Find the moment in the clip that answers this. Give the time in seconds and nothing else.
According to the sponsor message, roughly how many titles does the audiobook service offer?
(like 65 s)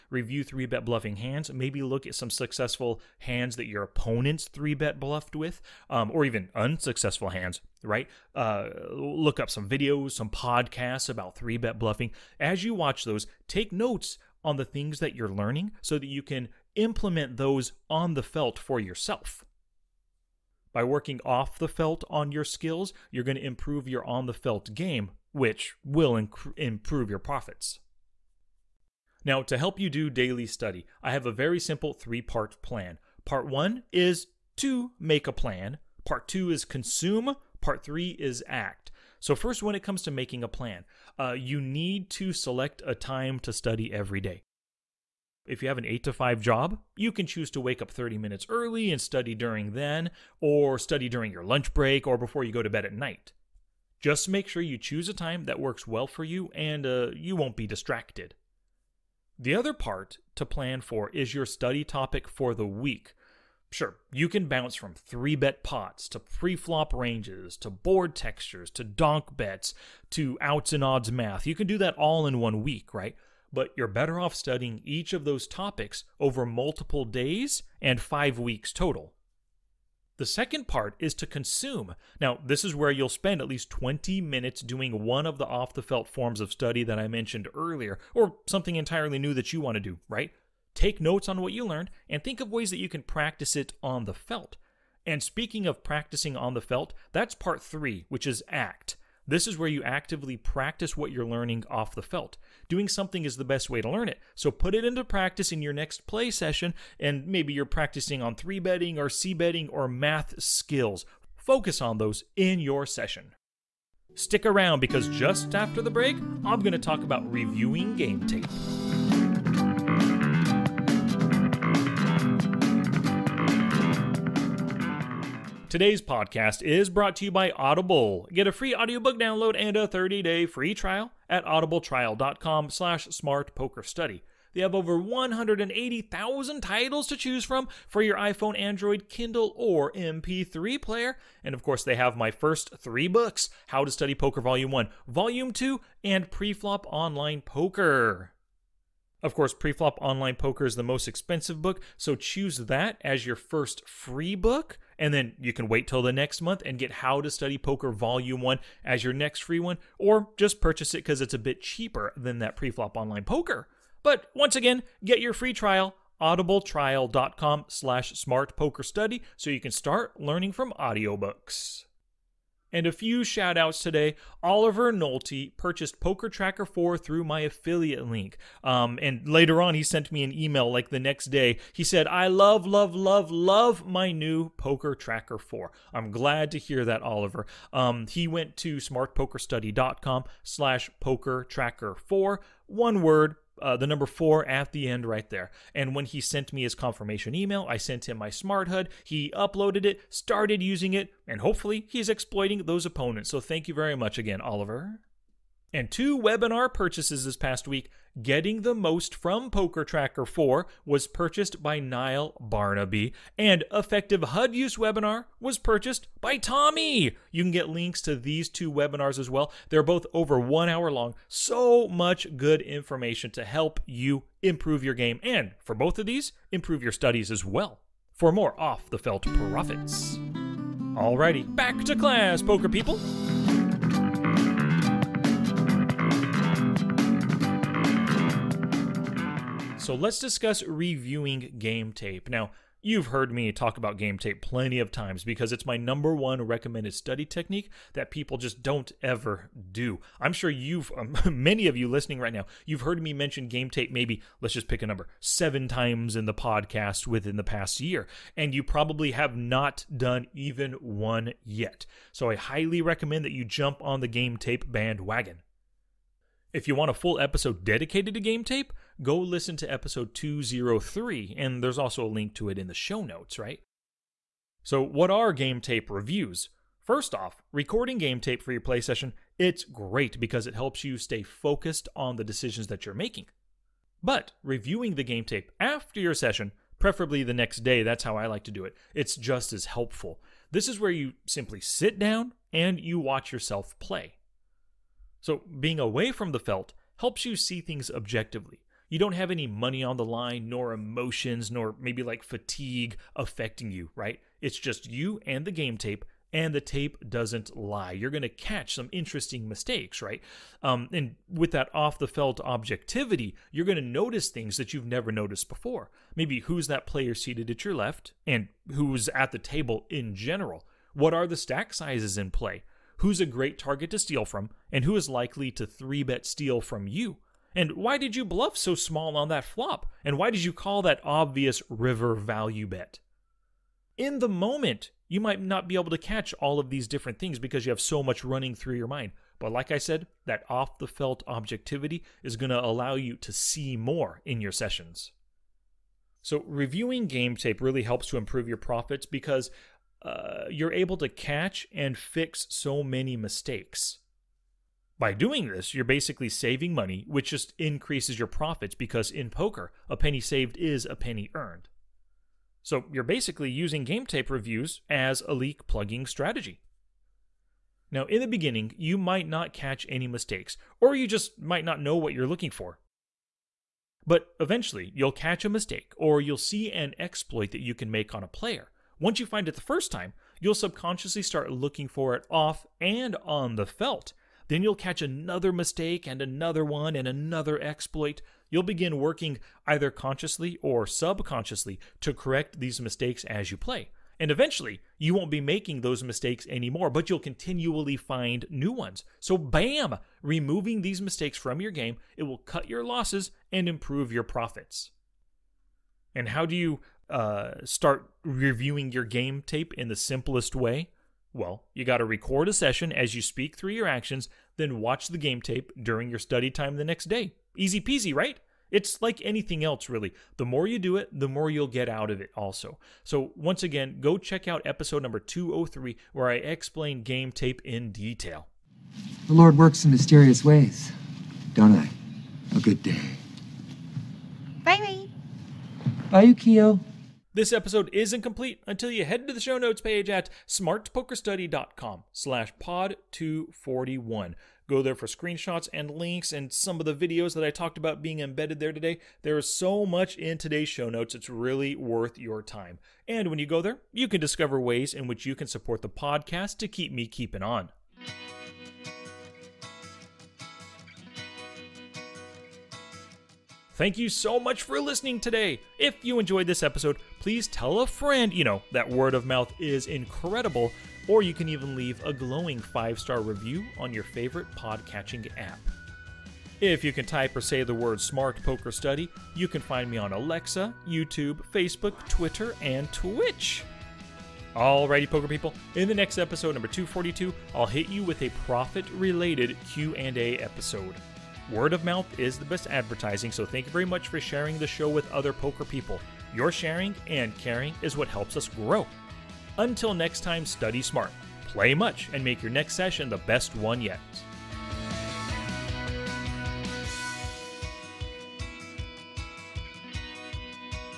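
134 s.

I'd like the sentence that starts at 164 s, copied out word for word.
But once again, get your free trial audibletrial.com slash smartpokerstudy so you can start learning from audiobooks.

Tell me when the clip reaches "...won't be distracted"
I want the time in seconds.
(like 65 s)
57 s.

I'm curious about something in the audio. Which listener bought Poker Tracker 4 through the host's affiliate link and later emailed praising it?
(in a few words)
Oliver Nolte.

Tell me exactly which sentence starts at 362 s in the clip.
So you're basically using game tape reviews as a leak plugging strategy.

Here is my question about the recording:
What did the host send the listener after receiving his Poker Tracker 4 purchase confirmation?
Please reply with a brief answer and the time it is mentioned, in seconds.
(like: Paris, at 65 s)
Smart HUD, at 198 s.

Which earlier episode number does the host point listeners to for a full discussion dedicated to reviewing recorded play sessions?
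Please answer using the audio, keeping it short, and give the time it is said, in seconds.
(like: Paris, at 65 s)
203, at 269 s.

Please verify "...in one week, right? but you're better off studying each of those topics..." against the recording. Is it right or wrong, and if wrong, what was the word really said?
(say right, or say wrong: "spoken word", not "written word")
right.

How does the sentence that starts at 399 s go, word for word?
So, bam, removing these mistakes from your game, it will cut your losses and improve your profits.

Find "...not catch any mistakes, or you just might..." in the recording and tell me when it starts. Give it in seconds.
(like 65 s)
369 s.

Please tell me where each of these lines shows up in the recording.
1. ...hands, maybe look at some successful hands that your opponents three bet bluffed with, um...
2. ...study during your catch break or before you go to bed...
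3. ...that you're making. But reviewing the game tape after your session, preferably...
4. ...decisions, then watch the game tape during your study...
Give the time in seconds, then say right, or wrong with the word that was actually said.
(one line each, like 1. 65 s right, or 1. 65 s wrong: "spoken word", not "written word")
1. 1 s right
2. 50 s wrong: "lunch", not "catch"
3. 282 s right
4. 413 s wrong: "actions", not "decisions".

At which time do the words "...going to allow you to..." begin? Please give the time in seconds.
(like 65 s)
342 s.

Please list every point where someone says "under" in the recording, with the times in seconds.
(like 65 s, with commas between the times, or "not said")
not said.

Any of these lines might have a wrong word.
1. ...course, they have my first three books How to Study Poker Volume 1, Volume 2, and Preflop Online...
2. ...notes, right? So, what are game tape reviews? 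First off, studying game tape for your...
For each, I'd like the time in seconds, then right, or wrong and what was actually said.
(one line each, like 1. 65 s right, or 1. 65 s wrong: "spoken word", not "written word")
1. 141 s right
2. 273 s wrong: "recording", not "studying".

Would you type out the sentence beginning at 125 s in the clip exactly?
Today's podcast is brought to you by Audible.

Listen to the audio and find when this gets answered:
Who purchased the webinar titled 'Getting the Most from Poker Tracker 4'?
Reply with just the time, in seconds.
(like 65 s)
211 s.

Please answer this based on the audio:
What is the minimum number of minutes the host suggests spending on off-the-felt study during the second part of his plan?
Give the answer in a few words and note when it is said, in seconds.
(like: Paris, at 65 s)
20, at 83 s.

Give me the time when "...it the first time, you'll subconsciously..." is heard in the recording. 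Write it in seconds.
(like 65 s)
379 s.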